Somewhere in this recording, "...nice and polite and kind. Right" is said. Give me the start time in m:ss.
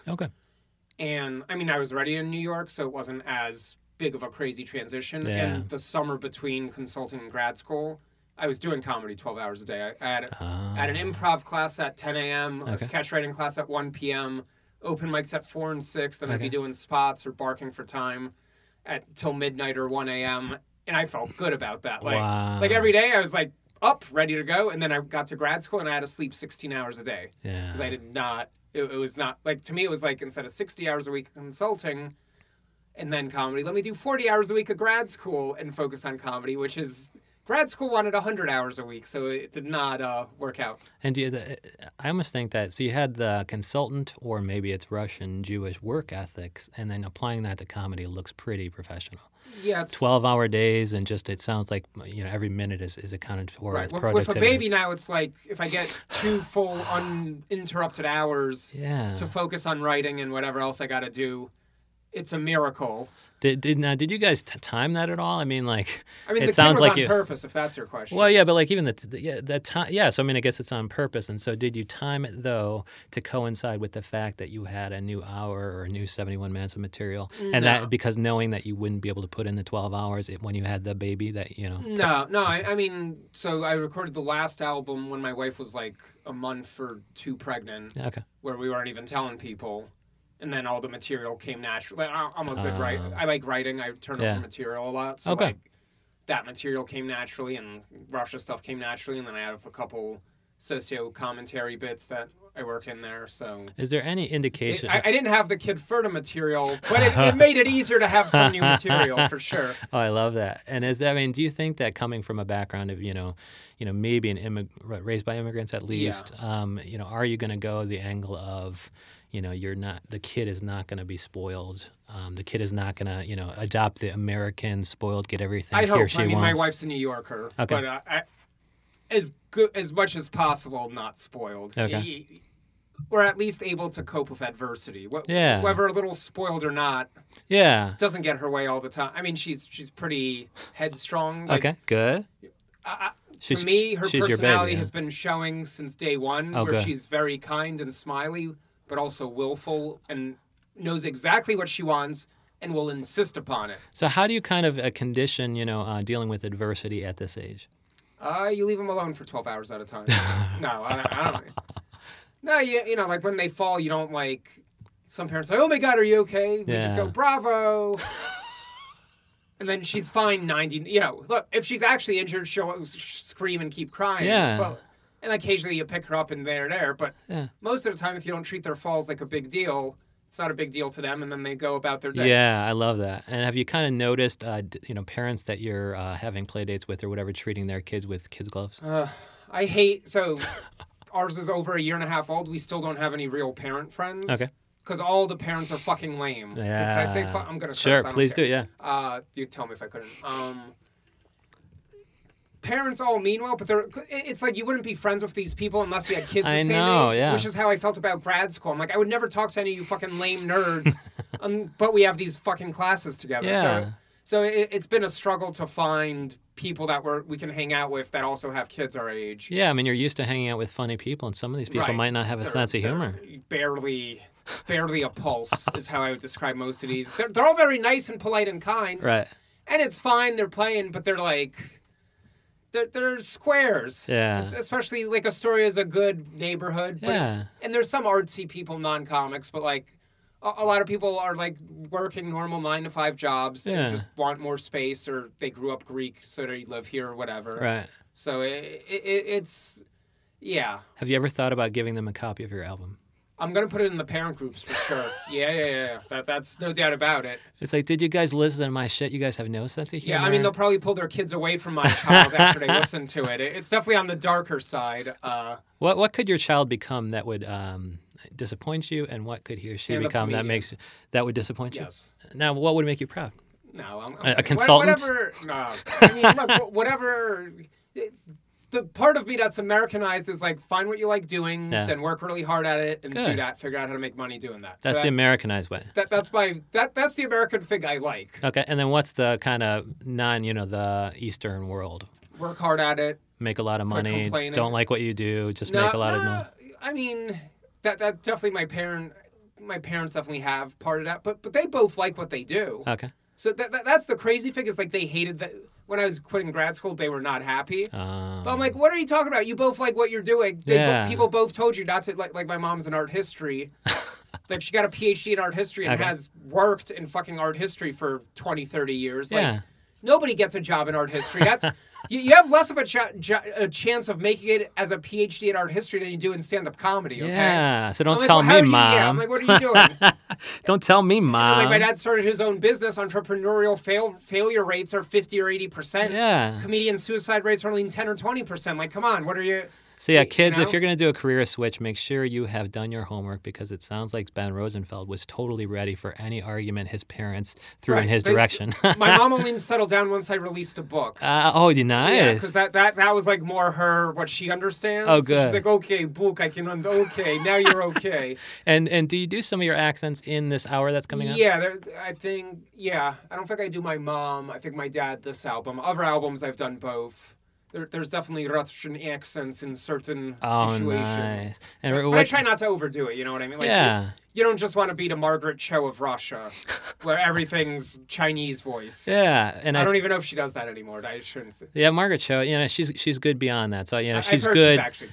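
3:47.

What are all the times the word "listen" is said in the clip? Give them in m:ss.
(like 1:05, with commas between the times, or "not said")
4:18, 4:22.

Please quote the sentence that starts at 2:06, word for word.
my wife's a new yorker okay.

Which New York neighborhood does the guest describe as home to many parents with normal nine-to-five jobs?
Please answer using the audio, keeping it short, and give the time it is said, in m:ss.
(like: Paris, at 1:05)
Astoria, at 3:55.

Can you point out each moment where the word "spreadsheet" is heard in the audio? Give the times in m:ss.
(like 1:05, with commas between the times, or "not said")
not said.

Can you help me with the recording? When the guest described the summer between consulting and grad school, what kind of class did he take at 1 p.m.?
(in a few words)
Sketch writing.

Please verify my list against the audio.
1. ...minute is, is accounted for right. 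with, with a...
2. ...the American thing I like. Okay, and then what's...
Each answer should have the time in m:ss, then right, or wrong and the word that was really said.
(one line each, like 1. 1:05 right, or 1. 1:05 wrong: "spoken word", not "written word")
1. 0:52 right
2. 4:47 right.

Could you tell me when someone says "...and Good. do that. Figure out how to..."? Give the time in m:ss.
4:43.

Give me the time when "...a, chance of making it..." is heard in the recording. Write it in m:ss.
5:23.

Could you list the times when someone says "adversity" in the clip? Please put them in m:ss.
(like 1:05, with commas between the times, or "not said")
2:14, 2:36.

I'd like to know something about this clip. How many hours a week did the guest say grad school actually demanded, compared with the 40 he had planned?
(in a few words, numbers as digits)
100.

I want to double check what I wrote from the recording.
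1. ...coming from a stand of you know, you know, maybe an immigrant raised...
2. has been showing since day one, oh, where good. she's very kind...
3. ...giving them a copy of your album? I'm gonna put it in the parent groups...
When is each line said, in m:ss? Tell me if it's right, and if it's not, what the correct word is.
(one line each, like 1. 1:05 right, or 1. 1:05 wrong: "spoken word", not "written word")
1. 1:51 wrong: "background", not "stand"
2. 2:24 right
3. 4:11 right.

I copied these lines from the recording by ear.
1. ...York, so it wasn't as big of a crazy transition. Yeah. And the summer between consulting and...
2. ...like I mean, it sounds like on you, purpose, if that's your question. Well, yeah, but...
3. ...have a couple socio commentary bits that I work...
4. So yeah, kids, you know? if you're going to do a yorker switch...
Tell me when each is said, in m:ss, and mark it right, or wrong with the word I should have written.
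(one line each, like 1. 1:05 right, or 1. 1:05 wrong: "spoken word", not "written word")
1. 0:02 right
2. 1:05 right
3. 1:39 right
4. 5:40 wrong: "career", not "yorker".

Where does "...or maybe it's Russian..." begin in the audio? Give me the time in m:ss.
0:44.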